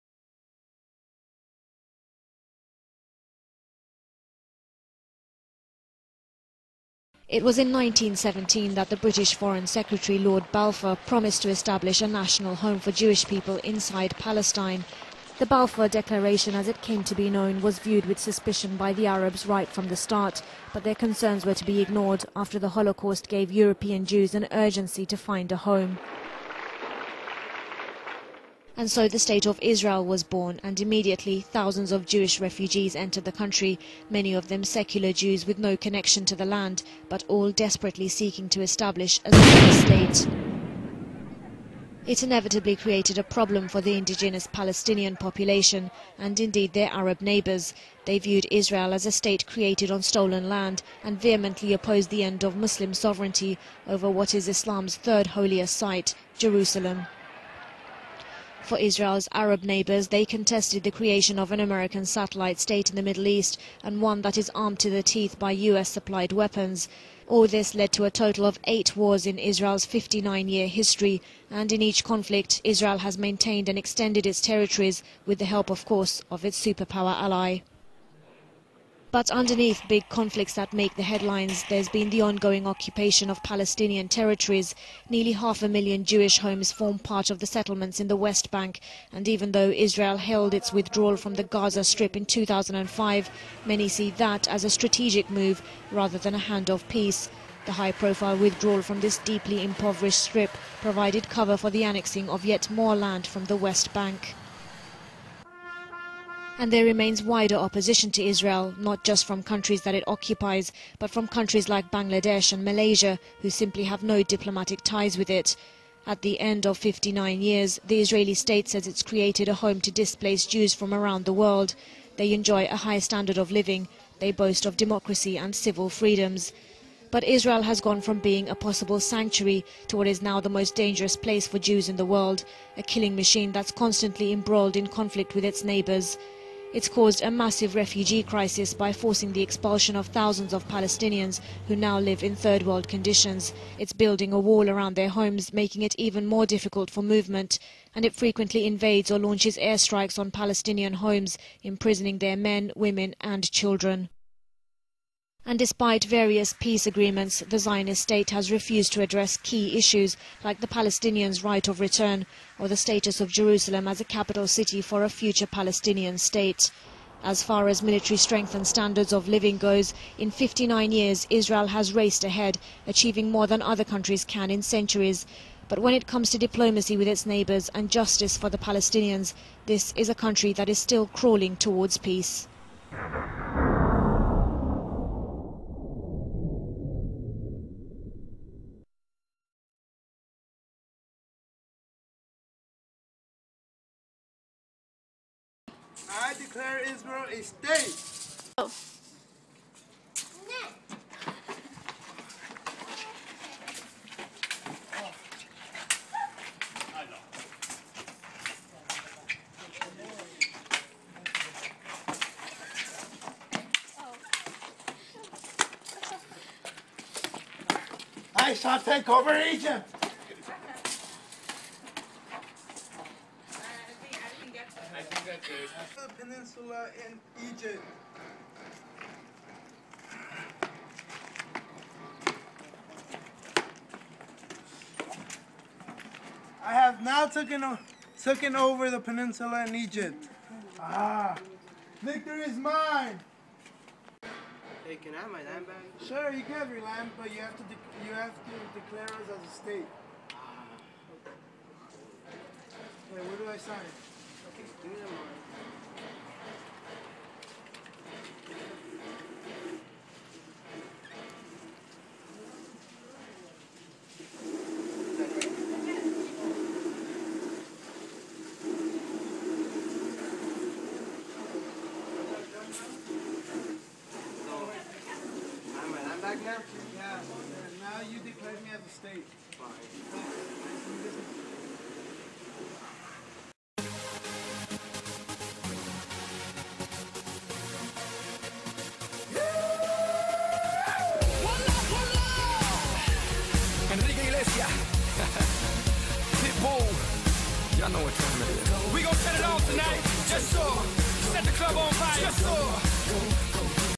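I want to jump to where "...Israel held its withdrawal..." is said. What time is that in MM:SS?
01:29.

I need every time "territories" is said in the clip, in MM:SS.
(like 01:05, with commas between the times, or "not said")
01:14, 01:24.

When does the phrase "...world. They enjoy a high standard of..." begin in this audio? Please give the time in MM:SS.
02:01.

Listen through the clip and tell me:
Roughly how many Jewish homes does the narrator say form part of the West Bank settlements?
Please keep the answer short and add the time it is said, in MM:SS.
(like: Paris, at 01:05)
Nearly half a million, at 01:25.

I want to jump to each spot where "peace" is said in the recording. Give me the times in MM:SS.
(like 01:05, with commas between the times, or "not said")
01:36, 02:36, 03:01.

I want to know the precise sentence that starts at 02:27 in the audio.
And it frequently invades or launches airstrikes on Palestinian homes, imprisoning their men, women and children.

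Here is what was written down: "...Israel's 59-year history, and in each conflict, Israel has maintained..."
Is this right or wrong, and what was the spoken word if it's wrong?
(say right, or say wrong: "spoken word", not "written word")
right.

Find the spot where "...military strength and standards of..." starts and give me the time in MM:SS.
02:47.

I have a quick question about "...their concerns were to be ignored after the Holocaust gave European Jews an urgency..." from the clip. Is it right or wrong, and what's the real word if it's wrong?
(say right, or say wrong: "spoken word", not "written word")
right.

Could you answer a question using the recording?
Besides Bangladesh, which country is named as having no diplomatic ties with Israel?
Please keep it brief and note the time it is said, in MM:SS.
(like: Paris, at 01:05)
Malaysia, at 01:52.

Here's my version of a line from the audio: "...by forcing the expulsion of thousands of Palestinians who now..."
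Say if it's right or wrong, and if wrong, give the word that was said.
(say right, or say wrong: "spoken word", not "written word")
right.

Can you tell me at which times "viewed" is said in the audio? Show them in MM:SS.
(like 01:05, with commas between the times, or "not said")
00:17, 00:48.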